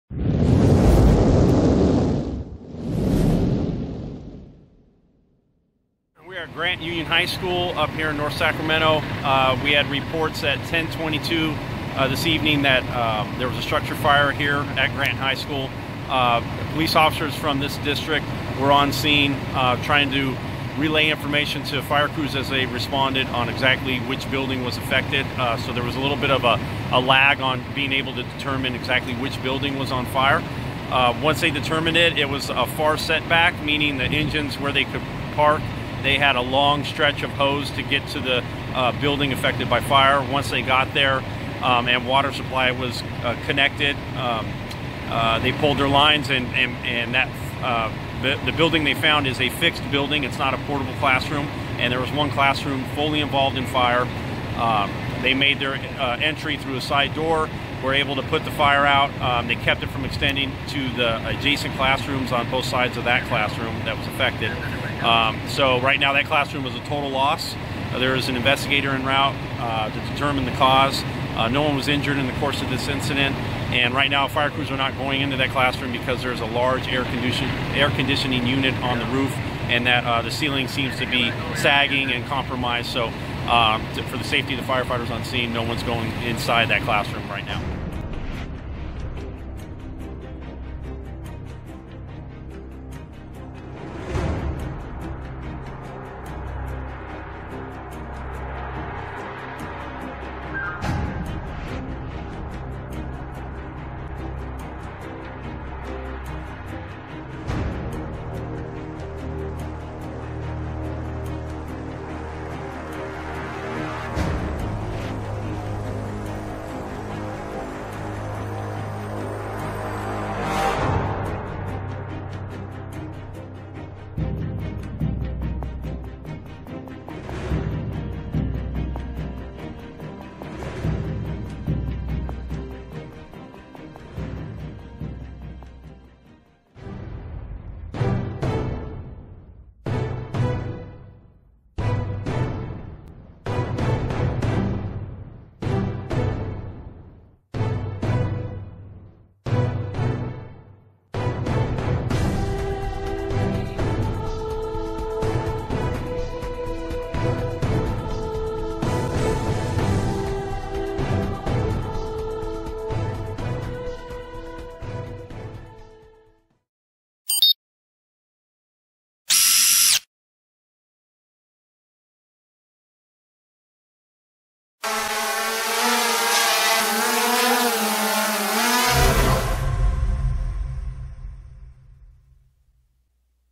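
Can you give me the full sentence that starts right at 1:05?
Um, so right now that classroom is a total loss.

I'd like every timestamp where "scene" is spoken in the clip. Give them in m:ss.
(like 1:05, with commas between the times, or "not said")
0:18, 1:25.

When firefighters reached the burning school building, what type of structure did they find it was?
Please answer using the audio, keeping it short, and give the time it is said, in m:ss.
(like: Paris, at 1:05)
fixed building, at 0:49.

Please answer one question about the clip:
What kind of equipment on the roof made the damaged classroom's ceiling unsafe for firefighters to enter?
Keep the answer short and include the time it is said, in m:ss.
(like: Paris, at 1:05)
air conditioning unit, at 1:17.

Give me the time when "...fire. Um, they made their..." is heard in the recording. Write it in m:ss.
0:53.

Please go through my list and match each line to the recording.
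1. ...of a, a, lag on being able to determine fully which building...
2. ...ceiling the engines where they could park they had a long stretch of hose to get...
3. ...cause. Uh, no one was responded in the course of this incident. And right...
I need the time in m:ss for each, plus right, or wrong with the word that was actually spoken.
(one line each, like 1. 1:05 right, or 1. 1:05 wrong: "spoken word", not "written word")
1. 0:26 wrong: "exactly", not "fully"
2. 0:33 wrong: "meaning", not "ceiling"
3. 1:10 wrong: "injured", not "responded".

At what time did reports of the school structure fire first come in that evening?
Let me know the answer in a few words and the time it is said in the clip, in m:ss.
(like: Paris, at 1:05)
10:22, at 0:10.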